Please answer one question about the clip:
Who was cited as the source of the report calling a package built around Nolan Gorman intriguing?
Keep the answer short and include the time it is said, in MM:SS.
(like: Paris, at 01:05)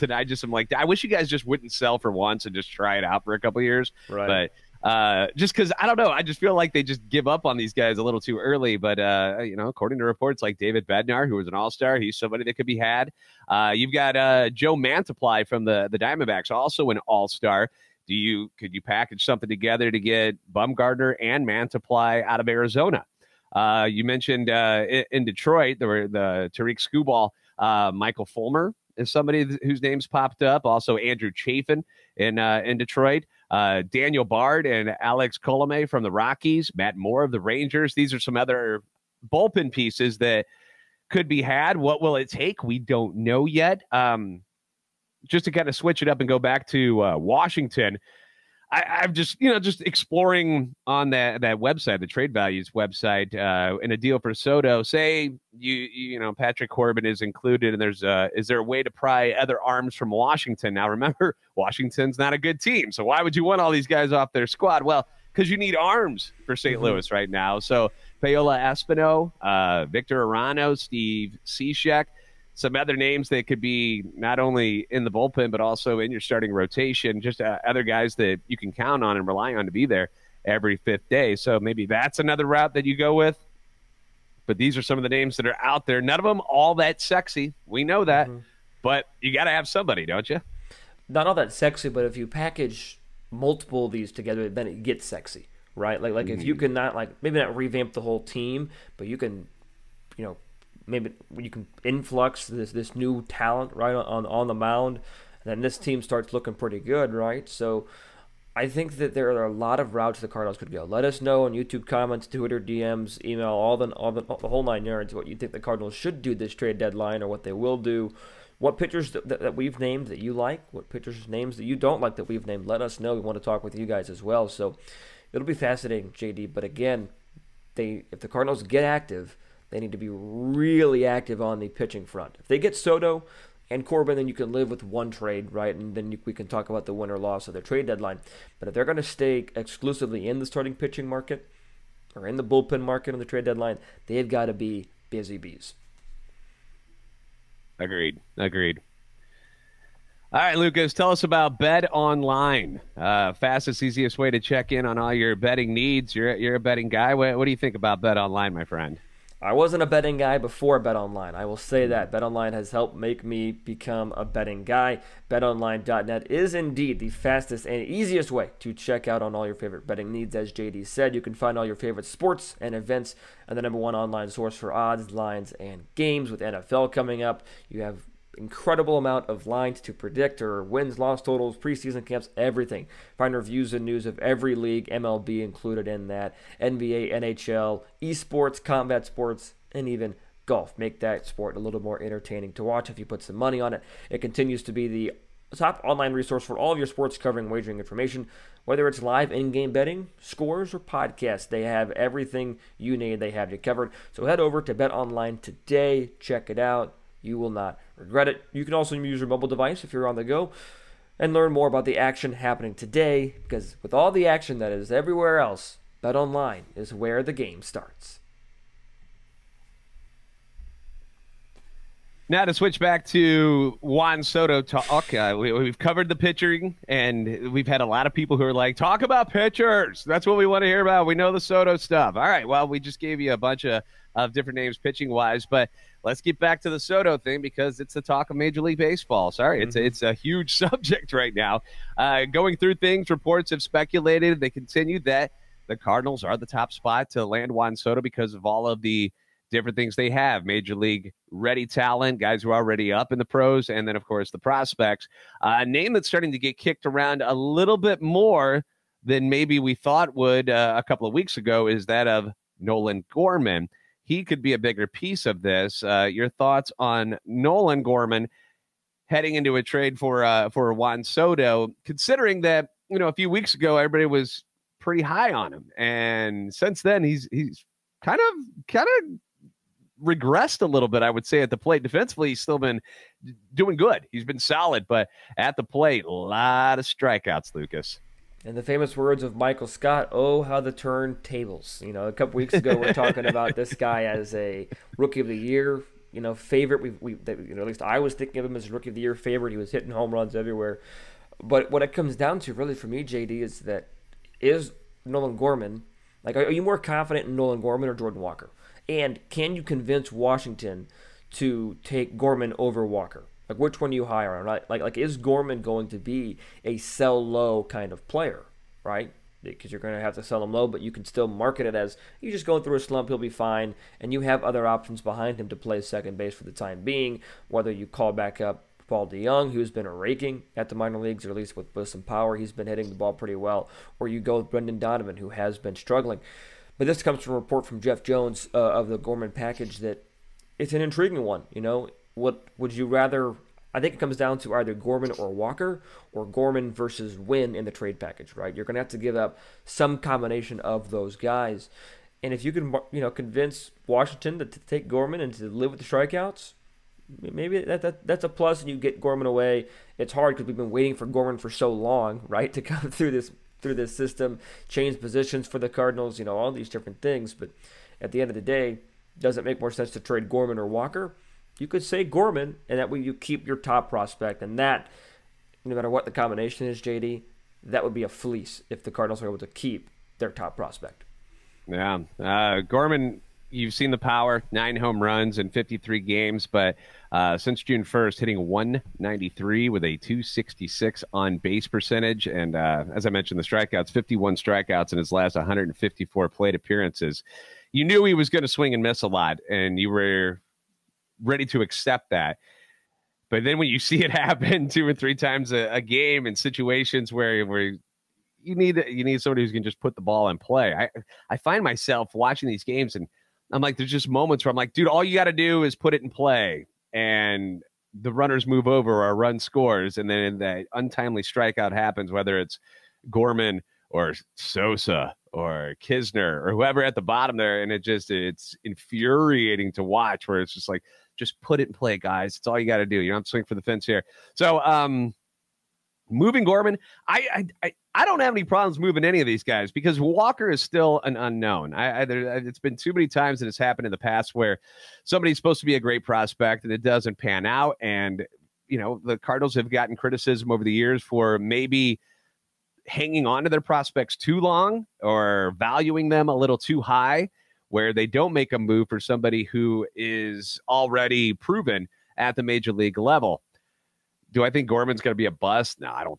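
Jeff Jones, at 05:37.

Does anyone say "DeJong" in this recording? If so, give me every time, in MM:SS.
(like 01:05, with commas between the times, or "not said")
05:29.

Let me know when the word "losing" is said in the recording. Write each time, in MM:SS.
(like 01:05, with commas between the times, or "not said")
not said.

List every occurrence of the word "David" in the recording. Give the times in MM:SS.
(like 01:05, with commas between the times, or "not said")
00:10.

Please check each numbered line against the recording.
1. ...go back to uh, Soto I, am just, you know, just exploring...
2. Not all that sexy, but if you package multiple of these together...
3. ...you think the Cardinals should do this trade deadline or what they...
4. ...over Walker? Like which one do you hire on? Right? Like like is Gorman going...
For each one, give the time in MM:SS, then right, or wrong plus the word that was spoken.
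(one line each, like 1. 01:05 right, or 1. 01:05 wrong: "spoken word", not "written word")
1. 00:46 wrong: "Washington", not "Soto"
2. 01:31 right
3. 01:55 right
4. 05:12 right.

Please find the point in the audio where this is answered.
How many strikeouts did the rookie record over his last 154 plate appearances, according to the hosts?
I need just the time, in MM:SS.
06:33.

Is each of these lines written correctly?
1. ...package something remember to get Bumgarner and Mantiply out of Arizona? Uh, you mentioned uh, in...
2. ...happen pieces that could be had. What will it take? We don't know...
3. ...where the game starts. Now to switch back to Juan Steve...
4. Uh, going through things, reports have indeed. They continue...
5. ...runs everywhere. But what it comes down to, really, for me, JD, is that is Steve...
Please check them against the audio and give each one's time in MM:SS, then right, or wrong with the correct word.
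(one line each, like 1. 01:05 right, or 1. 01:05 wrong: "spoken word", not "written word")
1. 00:18 wrong: "together", not "remember"
2. 00:39 wrong: "bullpen", not "happen"
3. 03:36 wrong: "Soto", not "Steve"
4. 04:01 wrong: "speculated", not "indeed"
5. 05:00 wrong: "Nolan", not "Steve".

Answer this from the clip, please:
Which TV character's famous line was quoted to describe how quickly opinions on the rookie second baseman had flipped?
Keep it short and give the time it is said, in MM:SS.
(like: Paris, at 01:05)
Michael Scott, at 04:49.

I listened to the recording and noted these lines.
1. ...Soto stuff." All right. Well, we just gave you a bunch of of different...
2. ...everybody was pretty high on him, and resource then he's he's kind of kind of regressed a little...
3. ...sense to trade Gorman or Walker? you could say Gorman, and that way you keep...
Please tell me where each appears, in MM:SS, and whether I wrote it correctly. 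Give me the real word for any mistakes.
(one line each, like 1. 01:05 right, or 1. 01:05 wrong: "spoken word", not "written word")
1. 03:51 right
2. 04:33 wrong: "since", not "resource"
3. 06:09 right.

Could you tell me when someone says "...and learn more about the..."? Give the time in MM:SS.
03:31.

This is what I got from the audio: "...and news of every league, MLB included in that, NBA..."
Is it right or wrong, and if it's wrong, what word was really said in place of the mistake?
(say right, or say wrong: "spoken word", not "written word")
right.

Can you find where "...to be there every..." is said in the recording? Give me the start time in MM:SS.
01:19.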